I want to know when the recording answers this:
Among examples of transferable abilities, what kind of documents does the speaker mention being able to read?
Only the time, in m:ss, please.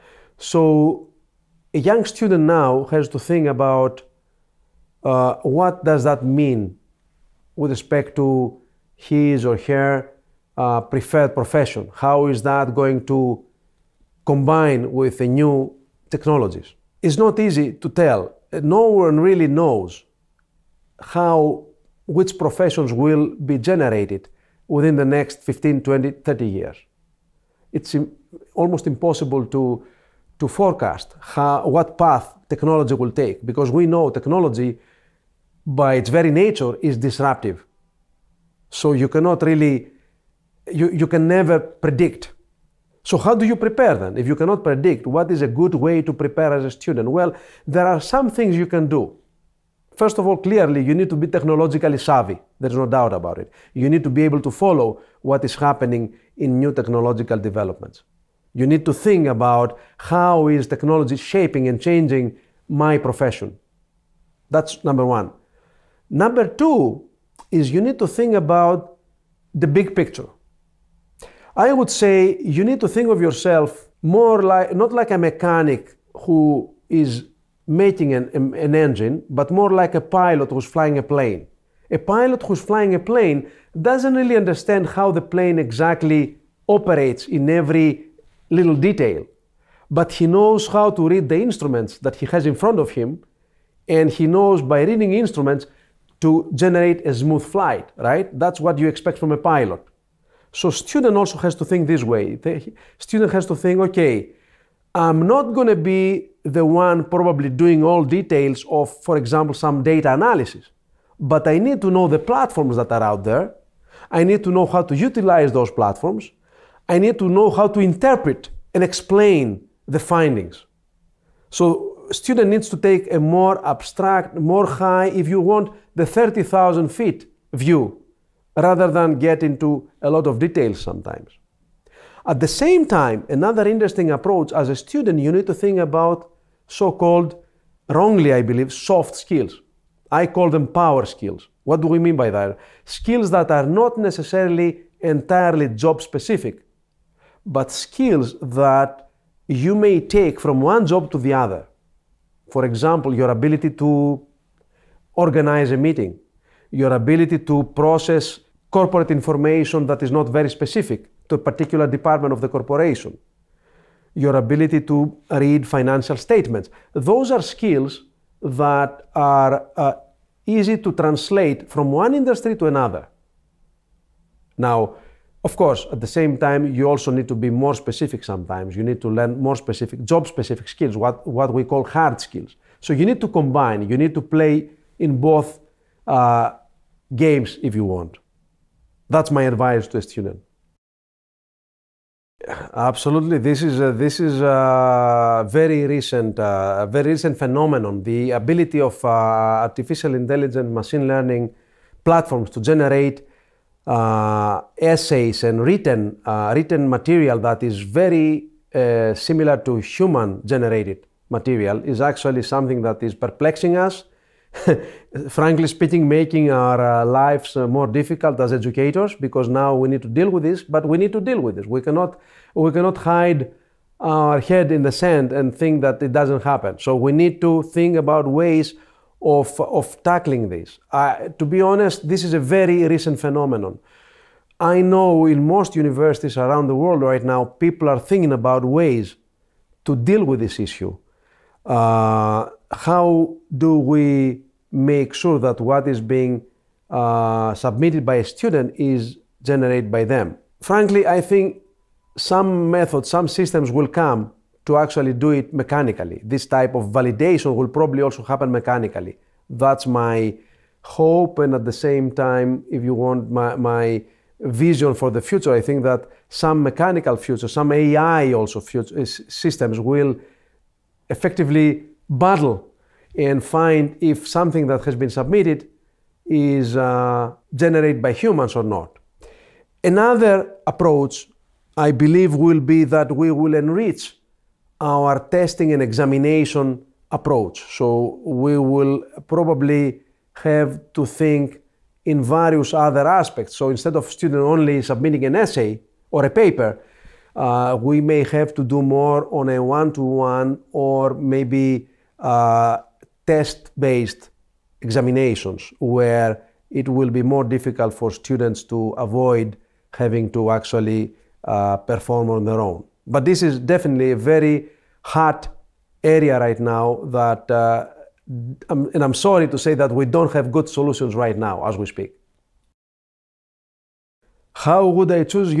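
2:45.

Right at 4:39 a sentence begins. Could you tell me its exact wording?
Another approach, I believe, will be that we will enrich our testing and examination approach.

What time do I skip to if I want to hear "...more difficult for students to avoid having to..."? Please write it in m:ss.
5:07.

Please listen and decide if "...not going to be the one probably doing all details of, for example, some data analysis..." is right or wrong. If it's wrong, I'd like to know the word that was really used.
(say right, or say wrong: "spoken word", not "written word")
right.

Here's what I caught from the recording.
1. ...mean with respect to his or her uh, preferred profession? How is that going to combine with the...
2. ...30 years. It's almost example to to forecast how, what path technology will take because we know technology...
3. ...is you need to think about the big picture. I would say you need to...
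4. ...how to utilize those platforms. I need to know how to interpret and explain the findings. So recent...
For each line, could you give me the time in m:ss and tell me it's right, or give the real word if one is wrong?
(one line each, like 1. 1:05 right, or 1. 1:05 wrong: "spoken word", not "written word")
1. 0:06 right
2. 0:26 wrong: "impossible", not "example"
3. 1:07 right
4. 1:54 wrong: "student", not "recent".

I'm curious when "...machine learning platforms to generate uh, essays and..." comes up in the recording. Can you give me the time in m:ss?
3:20.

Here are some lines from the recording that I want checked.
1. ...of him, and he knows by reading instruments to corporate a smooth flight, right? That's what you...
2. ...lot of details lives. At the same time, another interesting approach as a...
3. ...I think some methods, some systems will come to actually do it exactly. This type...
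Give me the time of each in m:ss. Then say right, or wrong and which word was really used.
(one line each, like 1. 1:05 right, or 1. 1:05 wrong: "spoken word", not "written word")
1. 1:32 wrong: "generate", not "corporate"
2. 2:10 wrong: "sometimes", not "lives"
3. 4:11 wrong: "mechanically", not "exactly".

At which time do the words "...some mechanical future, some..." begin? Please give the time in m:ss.
4:26.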